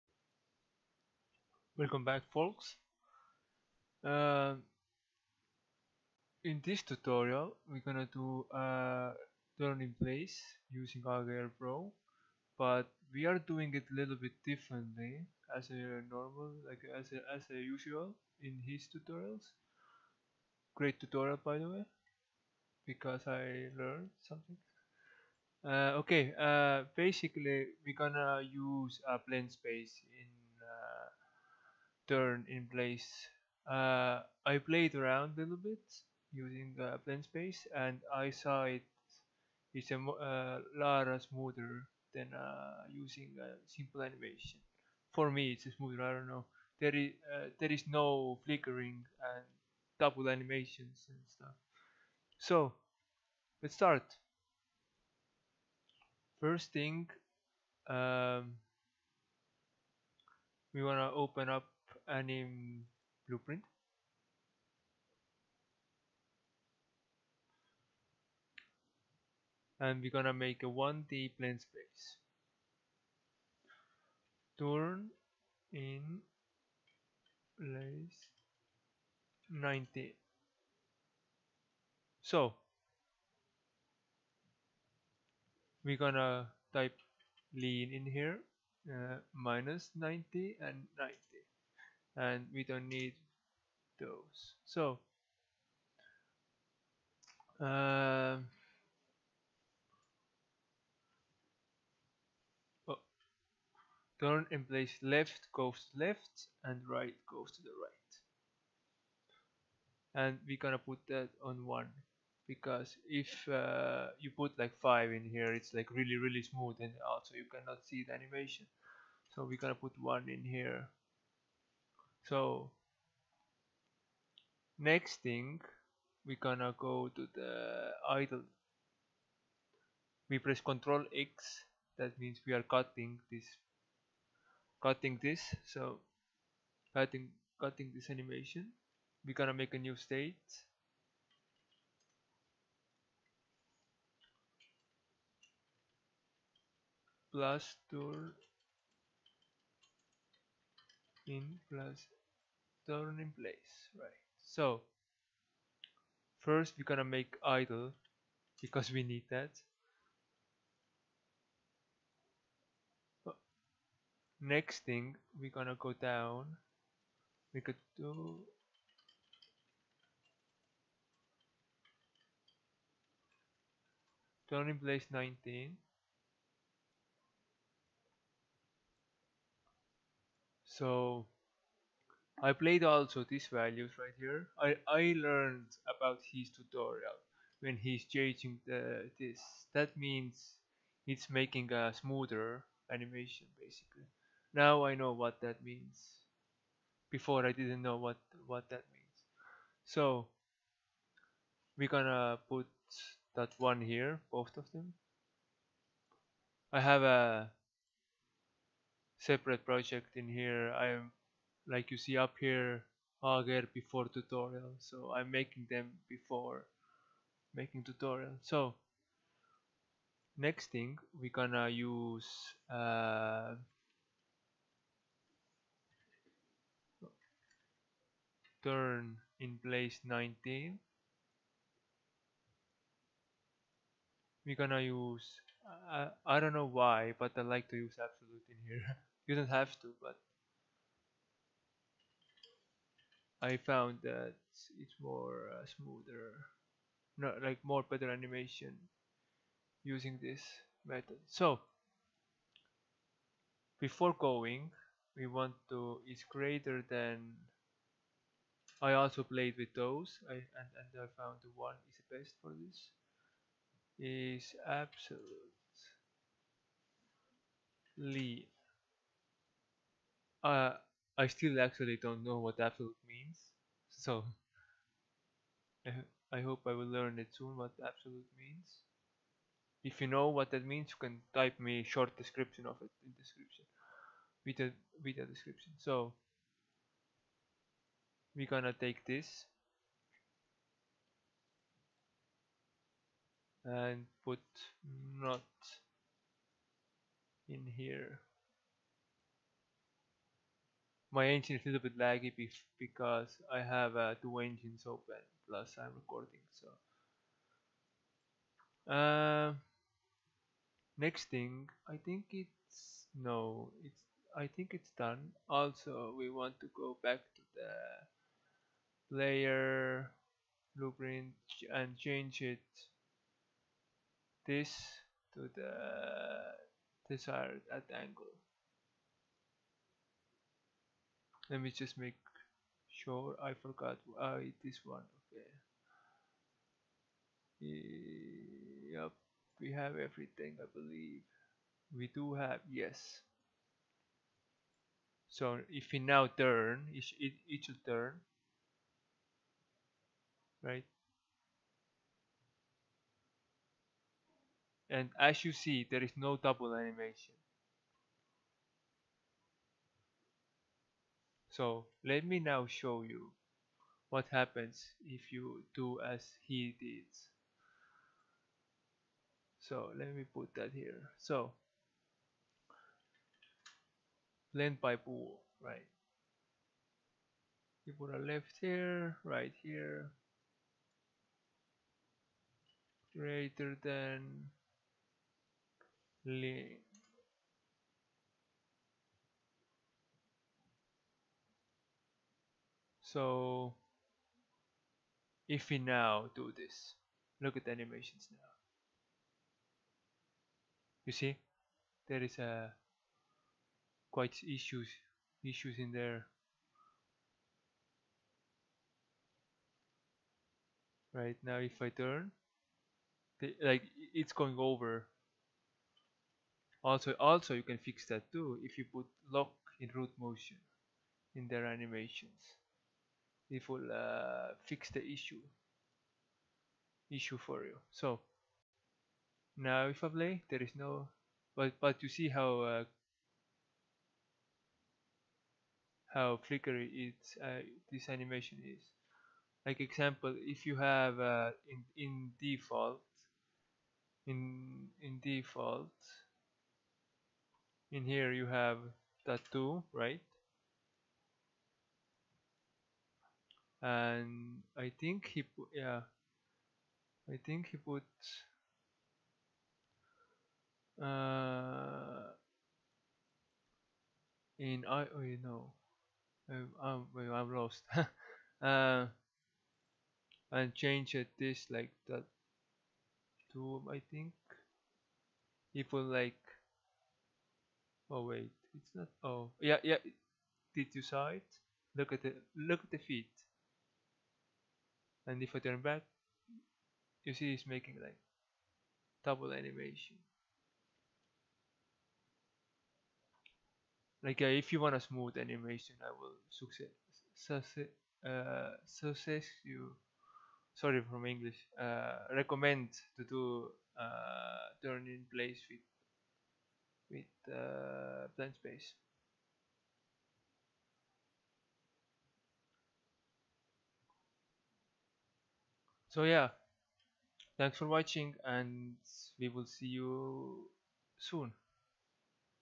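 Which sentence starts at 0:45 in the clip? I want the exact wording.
For me it's smoother, I don't know.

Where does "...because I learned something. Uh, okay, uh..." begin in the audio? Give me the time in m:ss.
0:22.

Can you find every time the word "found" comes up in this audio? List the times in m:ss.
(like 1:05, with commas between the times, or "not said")
4:03, 4:21.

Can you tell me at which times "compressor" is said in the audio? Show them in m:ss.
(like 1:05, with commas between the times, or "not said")
not said.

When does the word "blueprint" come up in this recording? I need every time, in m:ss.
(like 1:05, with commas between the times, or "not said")
1:03, 5:20.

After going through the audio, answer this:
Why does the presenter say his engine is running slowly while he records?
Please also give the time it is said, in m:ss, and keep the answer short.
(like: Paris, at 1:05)
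Two engines open, at 5:04.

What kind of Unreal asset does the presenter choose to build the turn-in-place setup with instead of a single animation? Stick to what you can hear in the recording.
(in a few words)
1D blend space.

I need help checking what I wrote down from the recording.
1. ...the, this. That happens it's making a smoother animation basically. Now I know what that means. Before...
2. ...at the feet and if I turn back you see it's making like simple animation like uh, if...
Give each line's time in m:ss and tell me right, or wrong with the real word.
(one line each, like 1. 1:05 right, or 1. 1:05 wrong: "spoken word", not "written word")
1. 3:08 wrong: "means", not "happens"
2. 8:02 wrong: "double", not "simple".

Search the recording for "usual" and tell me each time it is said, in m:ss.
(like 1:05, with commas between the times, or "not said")
0:17.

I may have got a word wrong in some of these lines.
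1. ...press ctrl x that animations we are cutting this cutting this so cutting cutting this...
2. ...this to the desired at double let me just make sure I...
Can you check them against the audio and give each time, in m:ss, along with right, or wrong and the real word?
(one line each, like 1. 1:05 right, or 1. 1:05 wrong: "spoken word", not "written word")
1. 2:10 wrong: "means", not "animations"
2. 5:24 wrong: "angle", not "double".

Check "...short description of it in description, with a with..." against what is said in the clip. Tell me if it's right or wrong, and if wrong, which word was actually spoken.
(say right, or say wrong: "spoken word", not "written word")
right.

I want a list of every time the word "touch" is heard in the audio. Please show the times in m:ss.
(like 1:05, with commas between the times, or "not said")
not said.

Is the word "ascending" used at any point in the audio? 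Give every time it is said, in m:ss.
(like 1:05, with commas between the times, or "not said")
not said.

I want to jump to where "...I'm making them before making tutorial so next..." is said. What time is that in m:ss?
3:35.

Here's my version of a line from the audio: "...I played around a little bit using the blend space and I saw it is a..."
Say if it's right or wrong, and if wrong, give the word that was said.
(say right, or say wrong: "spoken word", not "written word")
right.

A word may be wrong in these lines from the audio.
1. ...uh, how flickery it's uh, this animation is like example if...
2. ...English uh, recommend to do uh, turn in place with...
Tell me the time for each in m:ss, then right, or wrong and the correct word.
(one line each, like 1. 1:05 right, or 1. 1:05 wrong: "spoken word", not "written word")
1. 7:12 right
2. 8:21 right.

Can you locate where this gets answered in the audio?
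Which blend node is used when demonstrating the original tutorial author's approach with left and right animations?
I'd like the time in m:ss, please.
6:14.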